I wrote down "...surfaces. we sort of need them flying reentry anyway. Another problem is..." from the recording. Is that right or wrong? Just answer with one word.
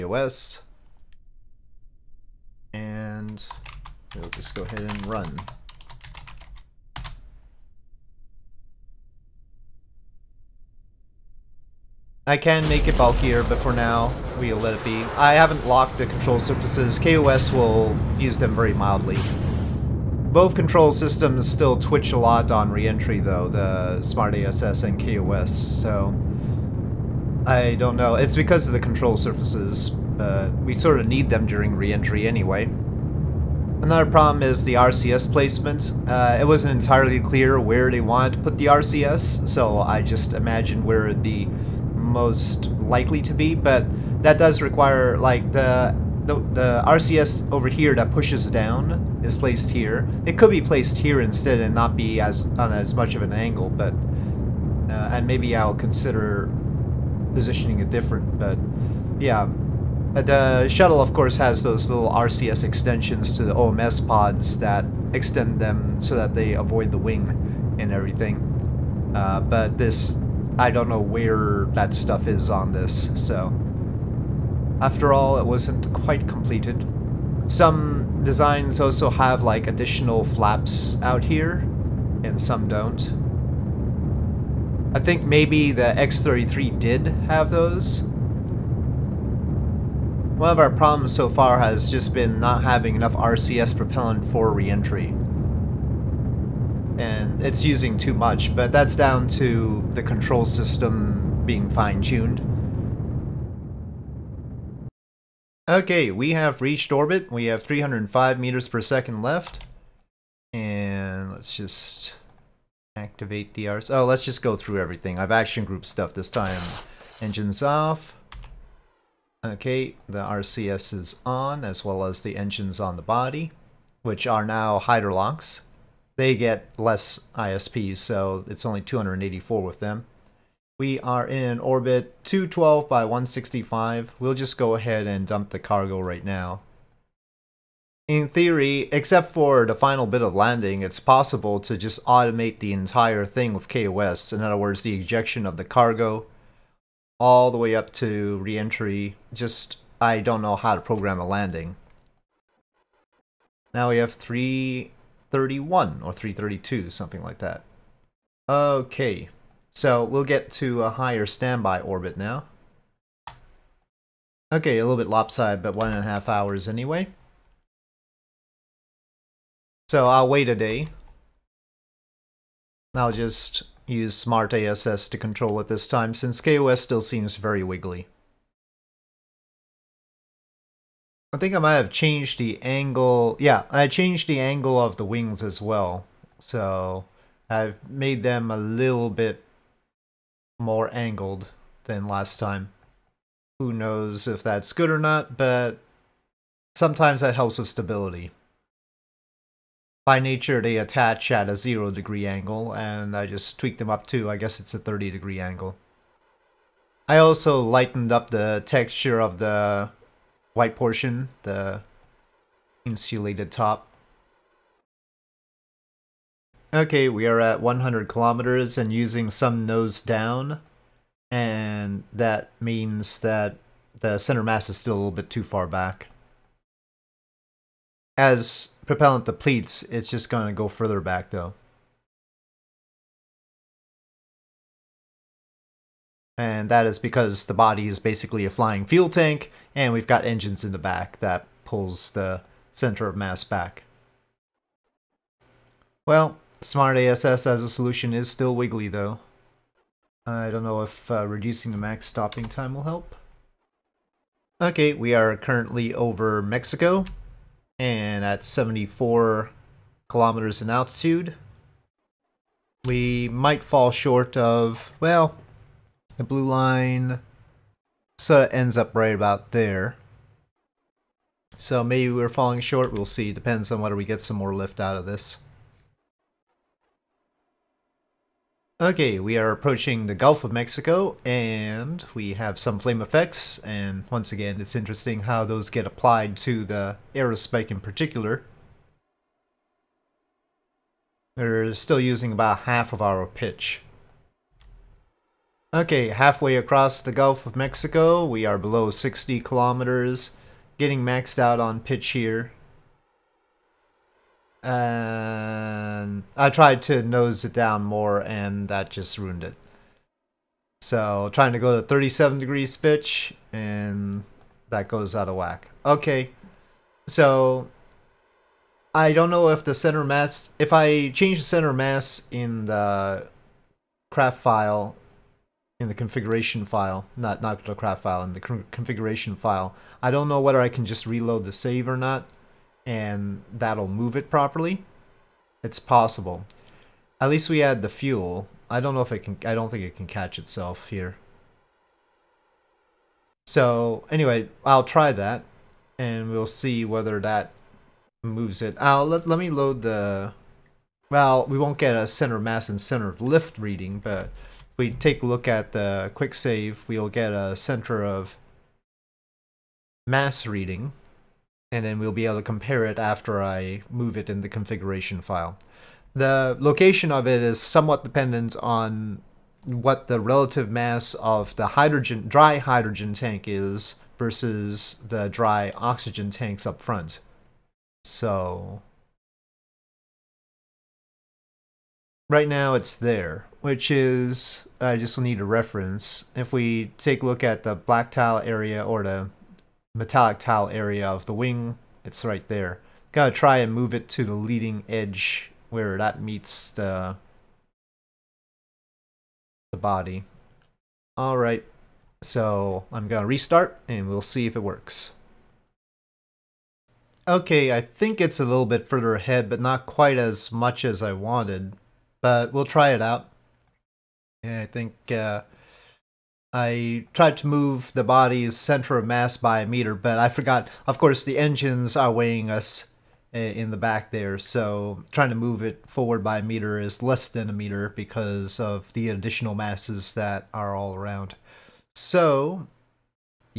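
wrong.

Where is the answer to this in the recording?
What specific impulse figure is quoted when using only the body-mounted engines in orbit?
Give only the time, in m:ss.
2:08.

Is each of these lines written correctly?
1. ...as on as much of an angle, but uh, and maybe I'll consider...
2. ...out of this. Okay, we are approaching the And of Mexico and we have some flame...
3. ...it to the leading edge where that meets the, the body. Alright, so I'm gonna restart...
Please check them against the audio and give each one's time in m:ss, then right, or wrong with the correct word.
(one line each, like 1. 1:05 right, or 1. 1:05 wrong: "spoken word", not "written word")
1. 0:52 right
2. 4:34 wrong: "Gulf", not "And"
3. 6:33 right.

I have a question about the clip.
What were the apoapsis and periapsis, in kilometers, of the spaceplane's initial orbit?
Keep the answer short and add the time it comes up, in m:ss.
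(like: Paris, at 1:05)
212 by 165, at 2:12.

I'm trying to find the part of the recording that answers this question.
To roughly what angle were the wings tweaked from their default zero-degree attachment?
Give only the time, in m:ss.
3:24.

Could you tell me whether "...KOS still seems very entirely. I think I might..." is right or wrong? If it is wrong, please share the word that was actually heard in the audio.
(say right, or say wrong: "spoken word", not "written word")
wrong: "wiggly", not "entirely".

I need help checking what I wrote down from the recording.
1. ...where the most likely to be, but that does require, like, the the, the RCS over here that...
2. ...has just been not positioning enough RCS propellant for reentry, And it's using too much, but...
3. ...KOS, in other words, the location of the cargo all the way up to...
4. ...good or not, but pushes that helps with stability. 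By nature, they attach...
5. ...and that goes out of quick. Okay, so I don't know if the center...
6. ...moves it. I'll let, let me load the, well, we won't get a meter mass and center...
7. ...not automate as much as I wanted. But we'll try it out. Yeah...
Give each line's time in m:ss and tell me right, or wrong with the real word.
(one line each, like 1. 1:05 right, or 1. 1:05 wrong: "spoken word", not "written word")
1. 0:40 right
2. 1:31 wrong: "having", not "positioning"
3. 2:23 wrong: "ejection", not "location"
4. 3:14 wrong: "sometimes", not "pushes"
5. 5:13 wrong: "whack", not "quick"
6. 5:48 wrong: "center", not "meter"
7. 6:49 wrong: "quite", not "automate".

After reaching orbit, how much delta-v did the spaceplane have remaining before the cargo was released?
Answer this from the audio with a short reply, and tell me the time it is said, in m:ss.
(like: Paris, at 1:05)
305 m/s, at 1:47.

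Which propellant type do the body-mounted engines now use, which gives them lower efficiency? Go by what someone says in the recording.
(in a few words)
Hydrolox.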